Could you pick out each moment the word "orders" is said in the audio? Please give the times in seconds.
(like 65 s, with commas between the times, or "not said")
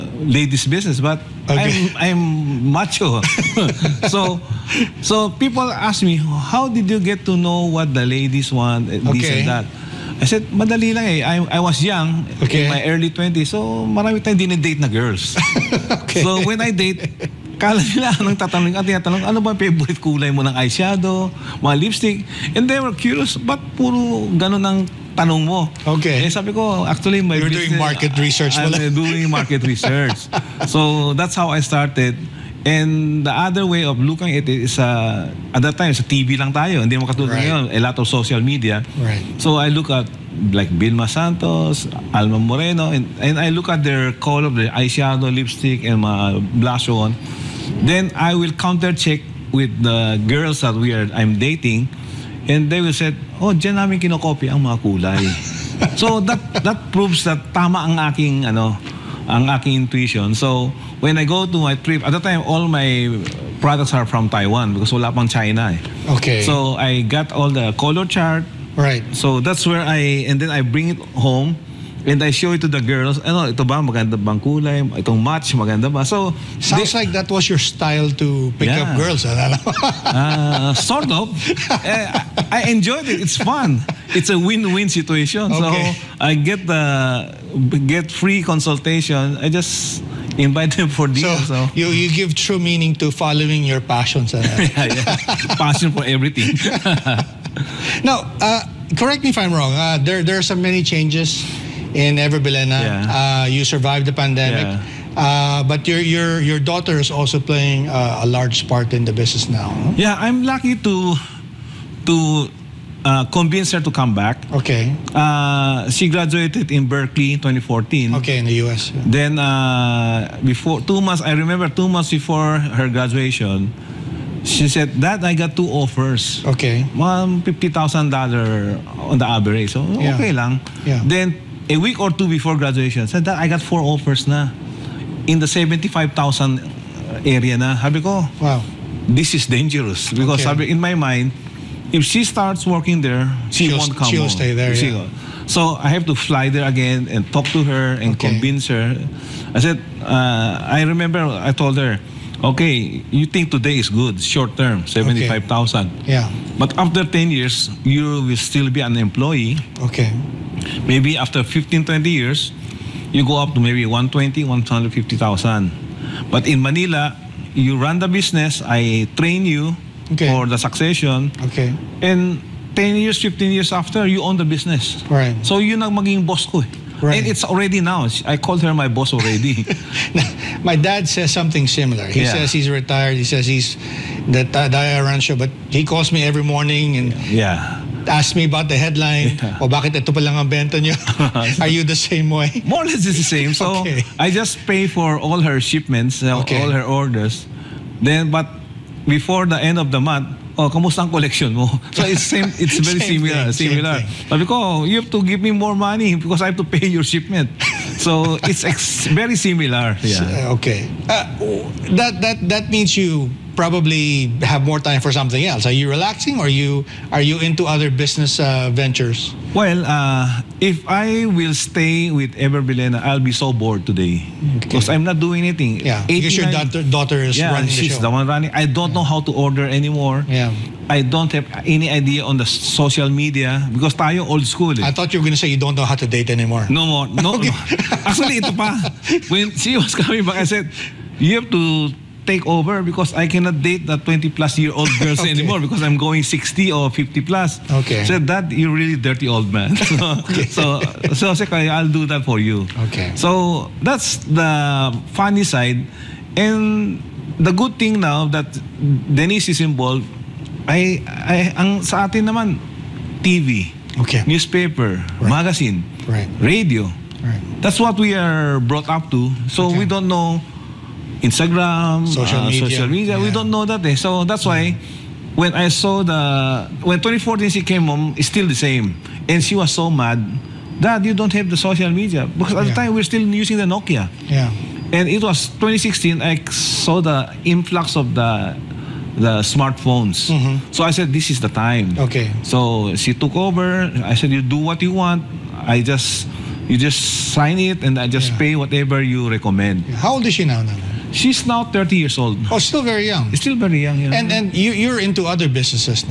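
196 s, 229 s.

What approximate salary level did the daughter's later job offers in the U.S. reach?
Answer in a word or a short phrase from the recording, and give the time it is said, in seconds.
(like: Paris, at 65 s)
75,000, at 135 s.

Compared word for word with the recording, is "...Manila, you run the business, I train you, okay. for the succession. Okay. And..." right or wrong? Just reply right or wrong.
right.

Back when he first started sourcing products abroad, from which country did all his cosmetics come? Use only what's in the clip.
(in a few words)
Taiwan.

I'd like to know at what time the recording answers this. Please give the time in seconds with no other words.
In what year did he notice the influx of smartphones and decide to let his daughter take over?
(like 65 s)
285 s.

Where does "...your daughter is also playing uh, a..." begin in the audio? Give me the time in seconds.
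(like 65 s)
106 s.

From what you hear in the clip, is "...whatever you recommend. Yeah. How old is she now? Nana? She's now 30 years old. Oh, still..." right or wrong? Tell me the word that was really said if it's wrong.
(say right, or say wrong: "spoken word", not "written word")
right.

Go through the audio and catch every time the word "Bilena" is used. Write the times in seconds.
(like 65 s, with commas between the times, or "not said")
102 s, 222 s.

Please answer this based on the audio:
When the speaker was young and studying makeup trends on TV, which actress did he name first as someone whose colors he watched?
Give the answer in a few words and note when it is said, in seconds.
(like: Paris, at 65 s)
Vilma Santos, at 40 s.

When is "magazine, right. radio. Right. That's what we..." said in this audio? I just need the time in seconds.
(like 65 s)
265 s.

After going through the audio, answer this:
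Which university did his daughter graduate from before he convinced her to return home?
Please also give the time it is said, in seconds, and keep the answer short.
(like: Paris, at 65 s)
Berkeley, at 116 s.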